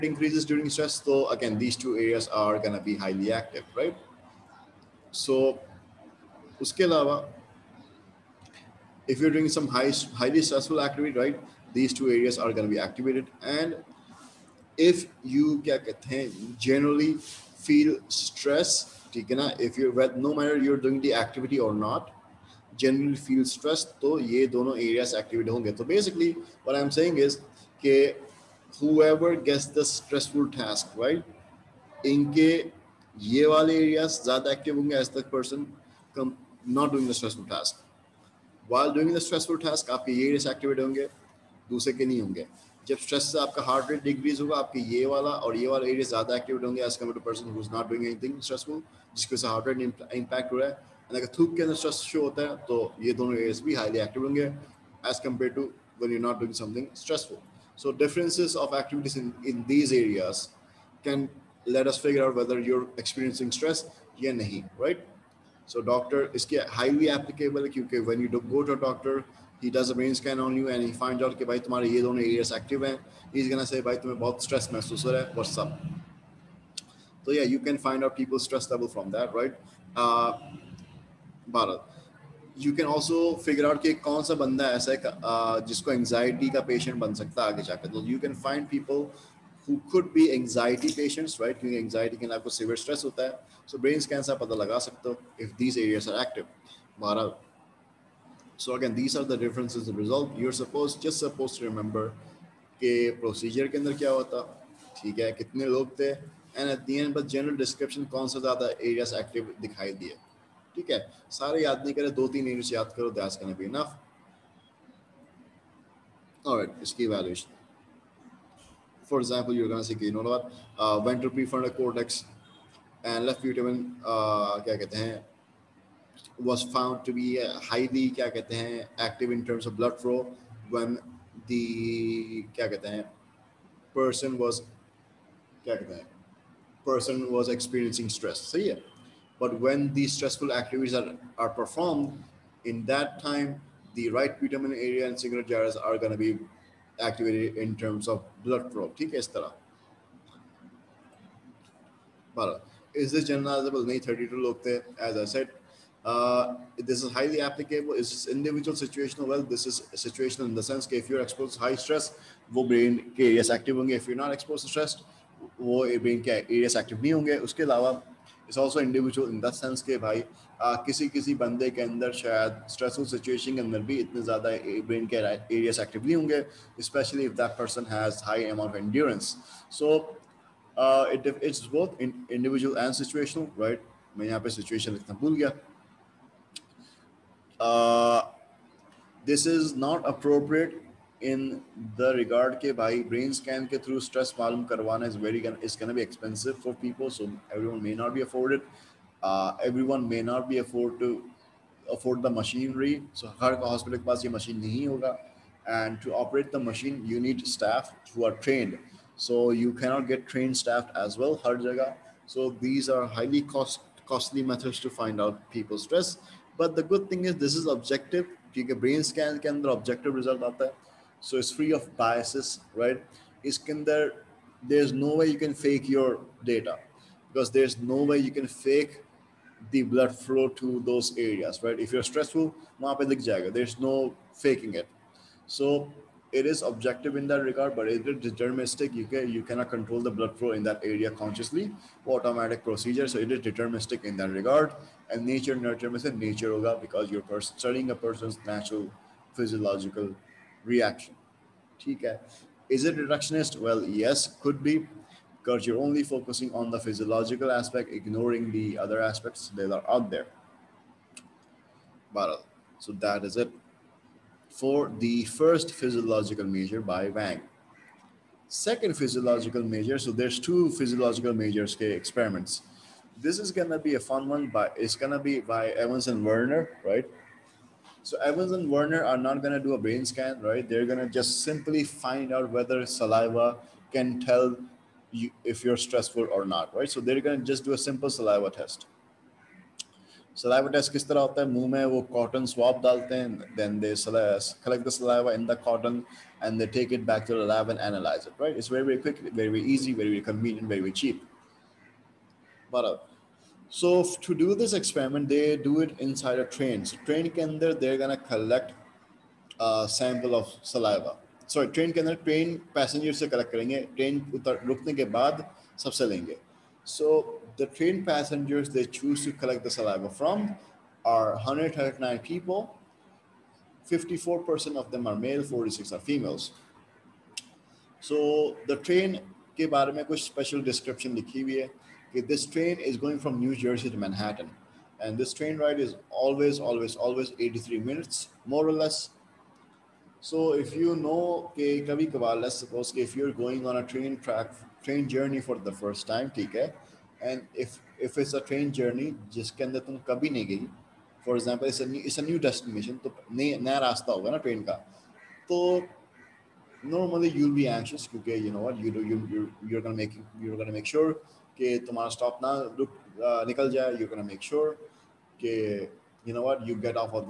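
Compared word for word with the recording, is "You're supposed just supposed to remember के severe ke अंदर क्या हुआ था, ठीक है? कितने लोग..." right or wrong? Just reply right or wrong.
wrong.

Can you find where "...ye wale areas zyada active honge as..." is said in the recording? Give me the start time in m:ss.
0:33.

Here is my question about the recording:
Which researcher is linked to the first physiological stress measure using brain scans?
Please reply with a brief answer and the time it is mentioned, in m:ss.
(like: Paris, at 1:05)
Wang, at 4:27.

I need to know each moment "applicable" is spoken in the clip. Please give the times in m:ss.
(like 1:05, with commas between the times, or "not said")
1:07, 2:37.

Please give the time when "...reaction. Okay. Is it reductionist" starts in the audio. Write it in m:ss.
4:10.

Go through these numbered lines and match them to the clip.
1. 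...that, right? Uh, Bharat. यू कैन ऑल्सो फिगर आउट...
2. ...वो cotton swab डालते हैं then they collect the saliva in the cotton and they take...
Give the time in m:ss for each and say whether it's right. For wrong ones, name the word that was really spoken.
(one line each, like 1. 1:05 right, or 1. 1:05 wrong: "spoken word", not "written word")
1. 1:19 right
2. 4:51 right.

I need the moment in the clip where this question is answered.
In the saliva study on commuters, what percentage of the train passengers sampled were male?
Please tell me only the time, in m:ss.
5:23.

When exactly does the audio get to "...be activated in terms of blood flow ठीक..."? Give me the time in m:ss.
2:26.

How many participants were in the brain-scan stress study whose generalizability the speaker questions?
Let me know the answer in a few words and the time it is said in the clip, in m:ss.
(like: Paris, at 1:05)
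32, at 2:34.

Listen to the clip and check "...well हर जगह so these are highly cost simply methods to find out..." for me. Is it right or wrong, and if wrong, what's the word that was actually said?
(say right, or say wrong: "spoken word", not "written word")
wrong: "costly", not "simply".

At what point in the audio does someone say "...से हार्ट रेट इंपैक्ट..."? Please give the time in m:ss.
0:49.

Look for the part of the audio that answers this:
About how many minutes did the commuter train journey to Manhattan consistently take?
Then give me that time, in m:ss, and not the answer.
5:37.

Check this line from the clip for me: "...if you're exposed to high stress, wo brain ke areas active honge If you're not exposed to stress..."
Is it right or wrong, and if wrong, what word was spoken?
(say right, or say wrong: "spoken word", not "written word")
right.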